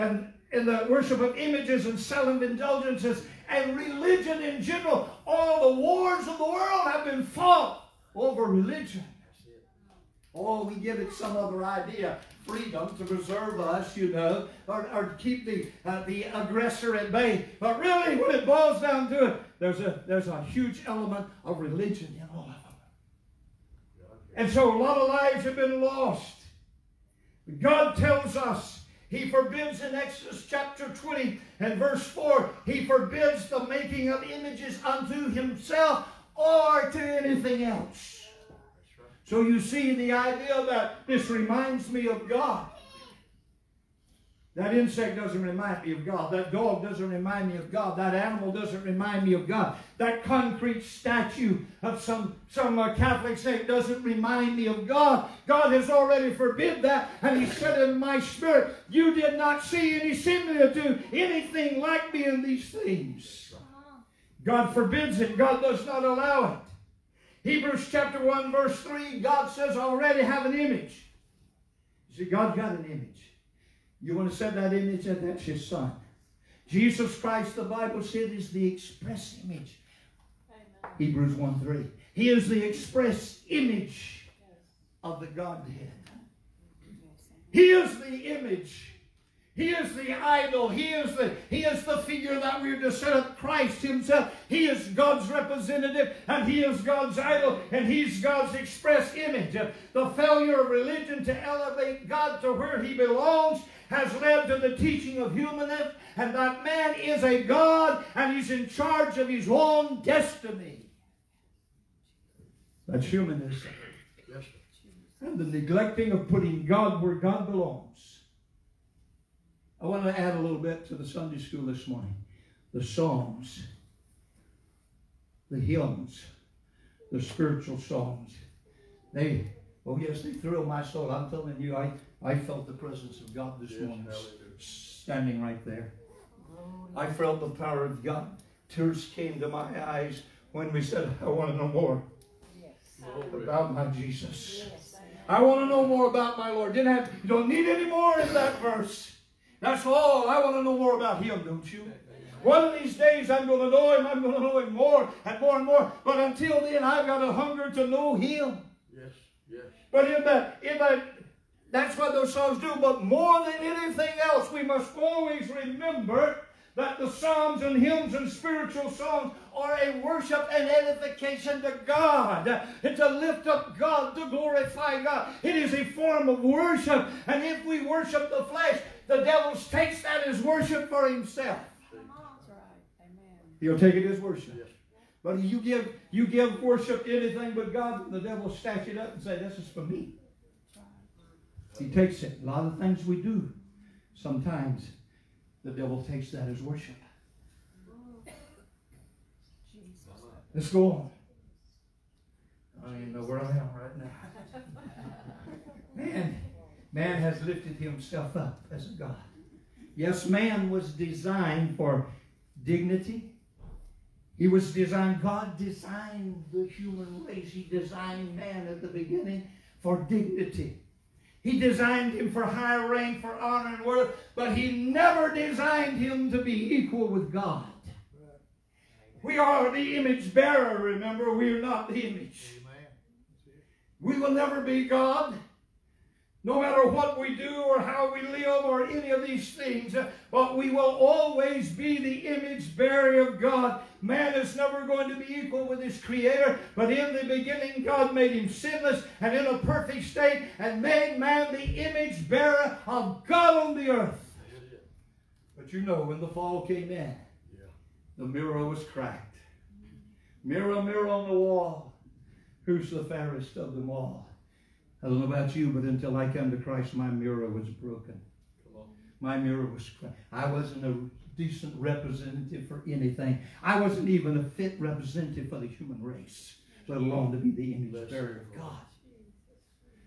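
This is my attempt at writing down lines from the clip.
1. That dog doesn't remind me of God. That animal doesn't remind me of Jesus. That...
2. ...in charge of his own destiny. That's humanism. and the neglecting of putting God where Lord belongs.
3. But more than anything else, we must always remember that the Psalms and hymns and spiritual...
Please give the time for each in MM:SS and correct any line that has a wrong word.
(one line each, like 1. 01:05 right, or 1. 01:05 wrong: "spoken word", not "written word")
1. 00:46 wrong: "God", not "Jesus"
2. 01:48 wrong: "God", not "Lord"
3. 02:42 right.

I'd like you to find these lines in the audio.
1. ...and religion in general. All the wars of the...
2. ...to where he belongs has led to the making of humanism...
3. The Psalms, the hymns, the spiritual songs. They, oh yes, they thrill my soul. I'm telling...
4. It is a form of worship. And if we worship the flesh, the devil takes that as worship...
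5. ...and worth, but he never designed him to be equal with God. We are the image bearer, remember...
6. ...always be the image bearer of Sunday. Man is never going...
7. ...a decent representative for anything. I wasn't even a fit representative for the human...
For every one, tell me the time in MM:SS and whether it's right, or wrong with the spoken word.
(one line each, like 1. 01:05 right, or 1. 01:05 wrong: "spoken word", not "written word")
1. 00:03 right
2. 01:42 wrong: "teaching", not "making"
3. 02:02 right
4. 02:55 right
5. 03:43 right
6. 04:00 wrong: "God", not "Sunday"
7. 04:30 right.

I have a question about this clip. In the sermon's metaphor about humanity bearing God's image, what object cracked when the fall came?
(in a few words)
The mirror.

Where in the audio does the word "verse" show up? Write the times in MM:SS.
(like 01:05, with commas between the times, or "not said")
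00:31, 01:08, 02:28.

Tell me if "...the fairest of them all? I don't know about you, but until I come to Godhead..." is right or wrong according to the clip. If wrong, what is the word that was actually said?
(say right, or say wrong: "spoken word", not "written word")
wrong: "Christ", not "Godhead".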